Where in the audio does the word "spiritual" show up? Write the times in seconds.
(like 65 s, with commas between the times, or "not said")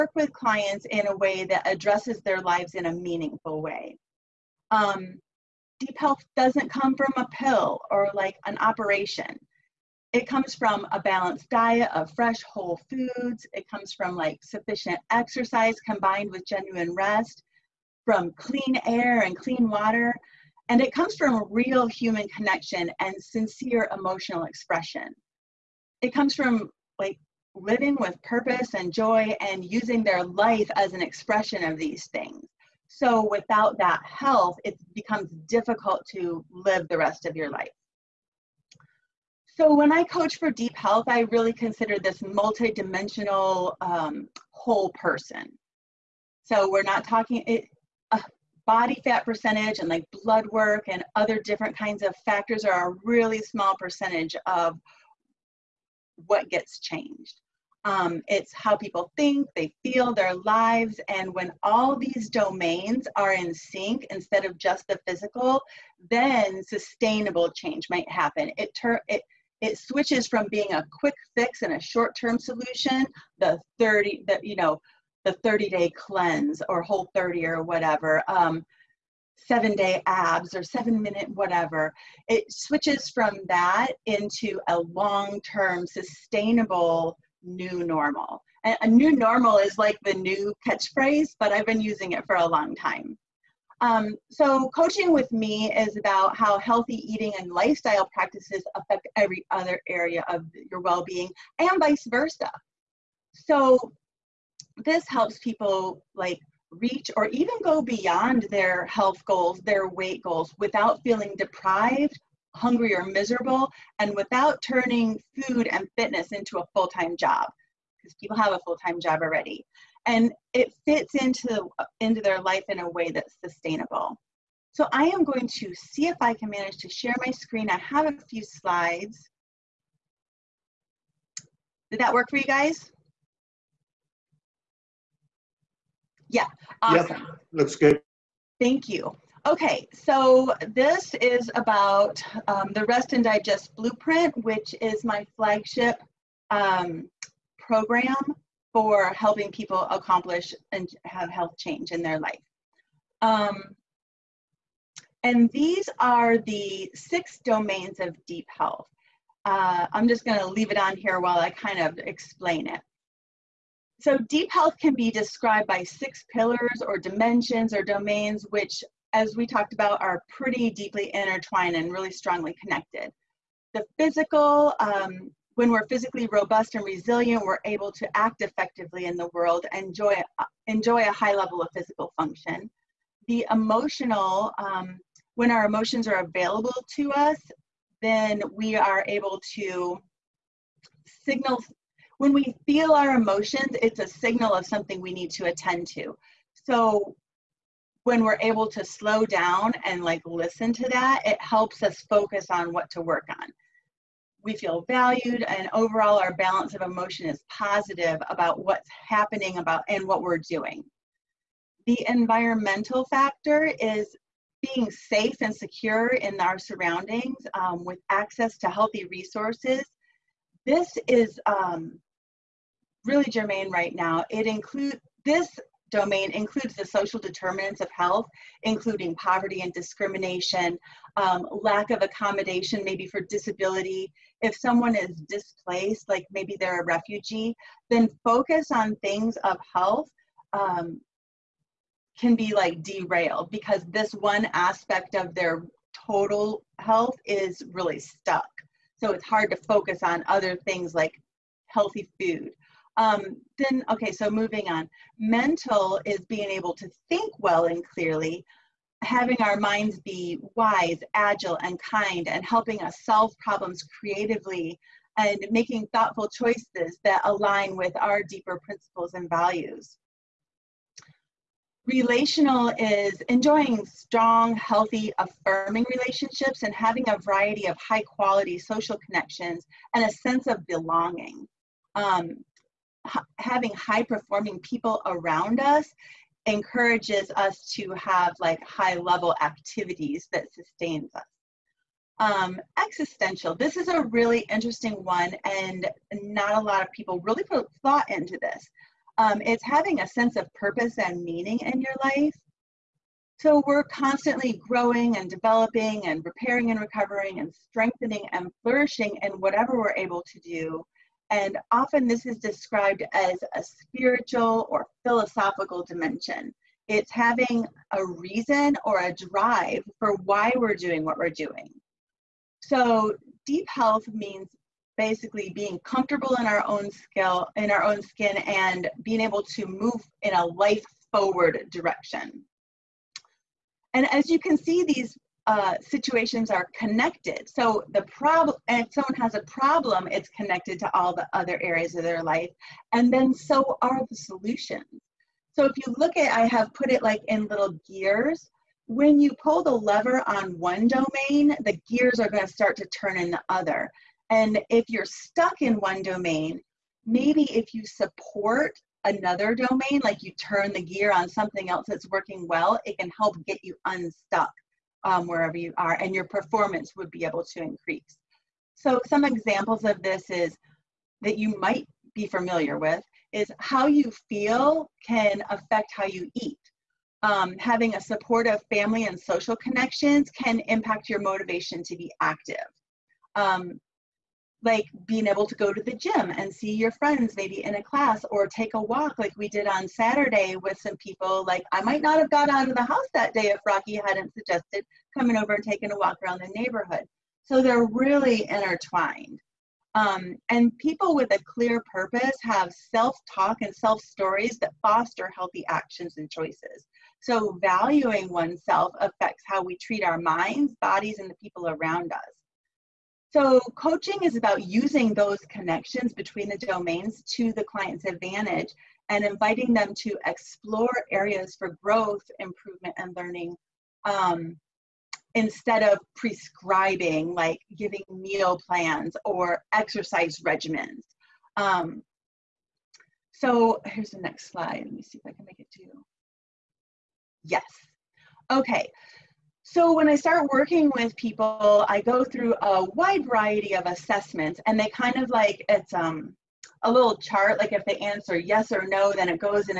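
313 s.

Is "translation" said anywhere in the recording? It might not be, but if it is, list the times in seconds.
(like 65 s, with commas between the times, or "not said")
not said.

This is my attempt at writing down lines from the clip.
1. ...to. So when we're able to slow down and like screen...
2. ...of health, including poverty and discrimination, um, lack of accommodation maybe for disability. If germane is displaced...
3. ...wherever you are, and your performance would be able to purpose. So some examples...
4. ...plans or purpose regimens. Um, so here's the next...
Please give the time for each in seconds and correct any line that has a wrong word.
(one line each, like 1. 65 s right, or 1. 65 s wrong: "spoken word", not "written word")
1. 195 s wrong: "listen", not "screen"
2. 227 s wrong: "someone", not "germane"
3. 365 s wrong: "increase", not "purpose"
4. 428 s wrong: "exercise", not "purpose".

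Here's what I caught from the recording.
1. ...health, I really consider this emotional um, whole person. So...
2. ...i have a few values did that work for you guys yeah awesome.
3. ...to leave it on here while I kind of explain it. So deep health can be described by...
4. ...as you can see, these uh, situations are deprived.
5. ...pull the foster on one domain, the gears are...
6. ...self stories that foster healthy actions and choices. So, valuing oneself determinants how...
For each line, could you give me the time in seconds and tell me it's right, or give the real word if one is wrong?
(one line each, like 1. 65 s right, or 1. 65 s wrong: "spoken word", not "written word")
1. 40 s wrong: "multidimensional", not "emotional"
2. 127 s wrong: "slides", not "values"
3. 160 s right
4. 334 s wrong: "connected", not "deprived"
5. 349 s wrong: "lever", not "foster"
6. 403 s wrong: "affects", not "determinants".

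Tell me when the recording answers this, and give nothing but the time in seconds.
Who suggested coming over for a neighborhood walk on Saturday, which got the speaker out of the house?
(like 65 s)
393 s.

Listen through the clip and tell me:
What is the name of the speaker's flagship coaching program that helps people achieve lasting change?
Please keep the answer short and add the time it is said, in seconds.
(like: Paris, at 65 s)
Rest and Digest Blueprint, at 142 s.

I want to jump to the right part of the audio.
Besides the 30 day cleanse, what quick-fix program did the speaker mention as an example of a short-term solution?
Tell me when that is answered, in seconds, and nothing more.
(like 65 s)
76 s.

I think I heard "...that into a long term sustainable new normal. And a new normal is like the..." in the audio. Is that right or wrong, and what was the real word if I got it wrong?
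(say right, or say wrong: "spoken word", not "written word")
right.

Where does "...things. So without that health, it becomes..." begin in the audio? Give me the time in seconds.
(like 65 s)
32 s.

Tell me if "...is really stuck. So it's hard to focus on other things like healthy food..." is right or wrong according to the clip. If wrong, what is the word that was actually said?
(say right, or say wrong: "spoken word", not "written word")
right.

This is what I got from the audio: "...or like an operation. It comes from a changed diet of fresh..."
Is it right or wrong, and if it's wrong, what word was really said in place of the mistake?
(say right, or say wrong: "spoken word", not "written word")
wrong: "balanced", not "changed".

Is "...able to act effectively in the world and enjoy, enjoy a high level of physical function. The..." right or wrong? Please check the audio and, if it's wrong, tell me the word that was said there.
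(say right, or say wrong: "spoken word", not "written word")
right.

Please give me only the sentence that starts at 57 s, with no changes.
Um, it's how people think, they feel, their lives.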